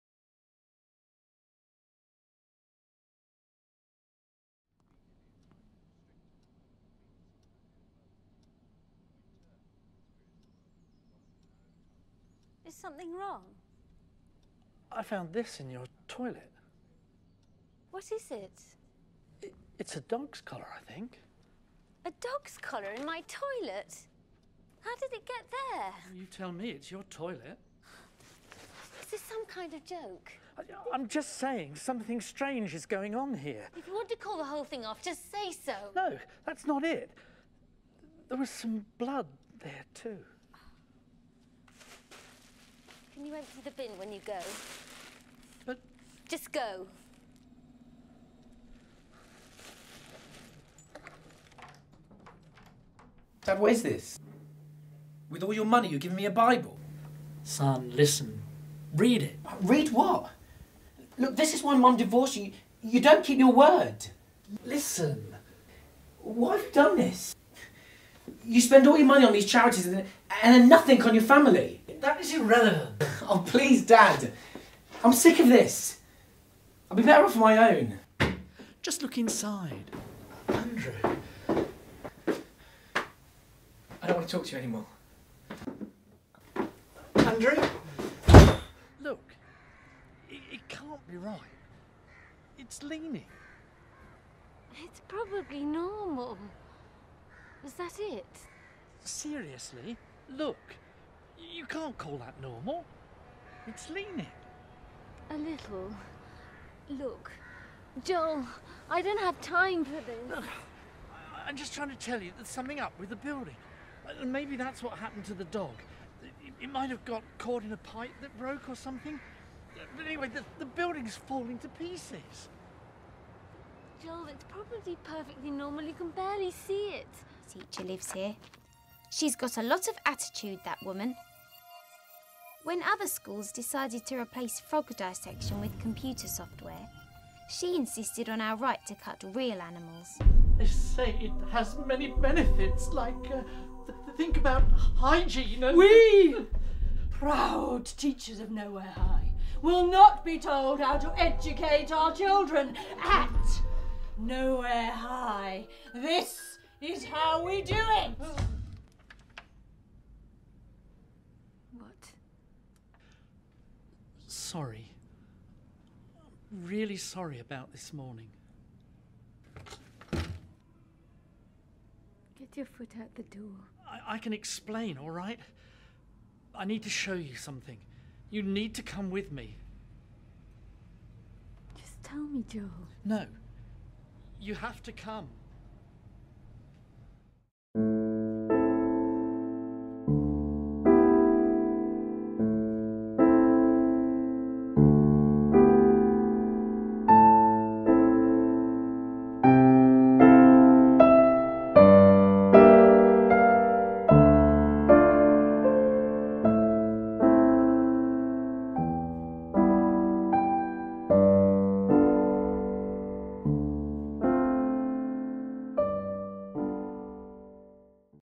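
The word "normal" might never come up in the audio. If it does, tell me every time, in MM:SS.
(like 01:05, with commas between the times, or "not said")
01:35, 01:42, 02:05.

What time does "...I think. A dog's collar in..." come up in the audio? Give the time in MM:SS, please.
00:20.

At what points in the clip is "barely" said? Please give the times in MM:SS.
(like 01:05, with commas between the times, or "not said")
02:06.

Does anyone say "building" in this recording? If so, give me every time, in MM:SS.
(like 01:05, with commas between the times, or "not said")
01:53, 02:00.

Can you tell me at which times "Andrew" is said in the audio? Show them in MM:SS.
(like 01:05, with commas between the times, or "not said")
01:20, 01:27.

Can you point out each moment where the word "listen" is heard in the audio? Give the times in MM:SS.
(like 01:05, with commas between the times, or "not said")
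00:57, 01:04.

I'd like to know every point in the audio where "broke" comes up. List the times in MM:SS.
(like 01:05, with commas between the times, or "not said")
01:58.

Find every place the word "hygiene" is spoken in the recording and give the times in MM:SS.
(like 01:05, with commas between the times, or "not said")
02:24.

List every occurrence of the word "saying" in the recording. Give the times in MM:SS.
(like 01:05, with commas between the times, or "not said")
00:31.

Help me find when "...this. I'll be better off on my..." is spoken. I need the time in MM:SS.
01:15.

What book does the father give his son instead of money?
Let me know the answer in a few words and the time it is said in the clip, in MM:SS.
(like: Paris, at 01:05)
A Bible, at 00:56.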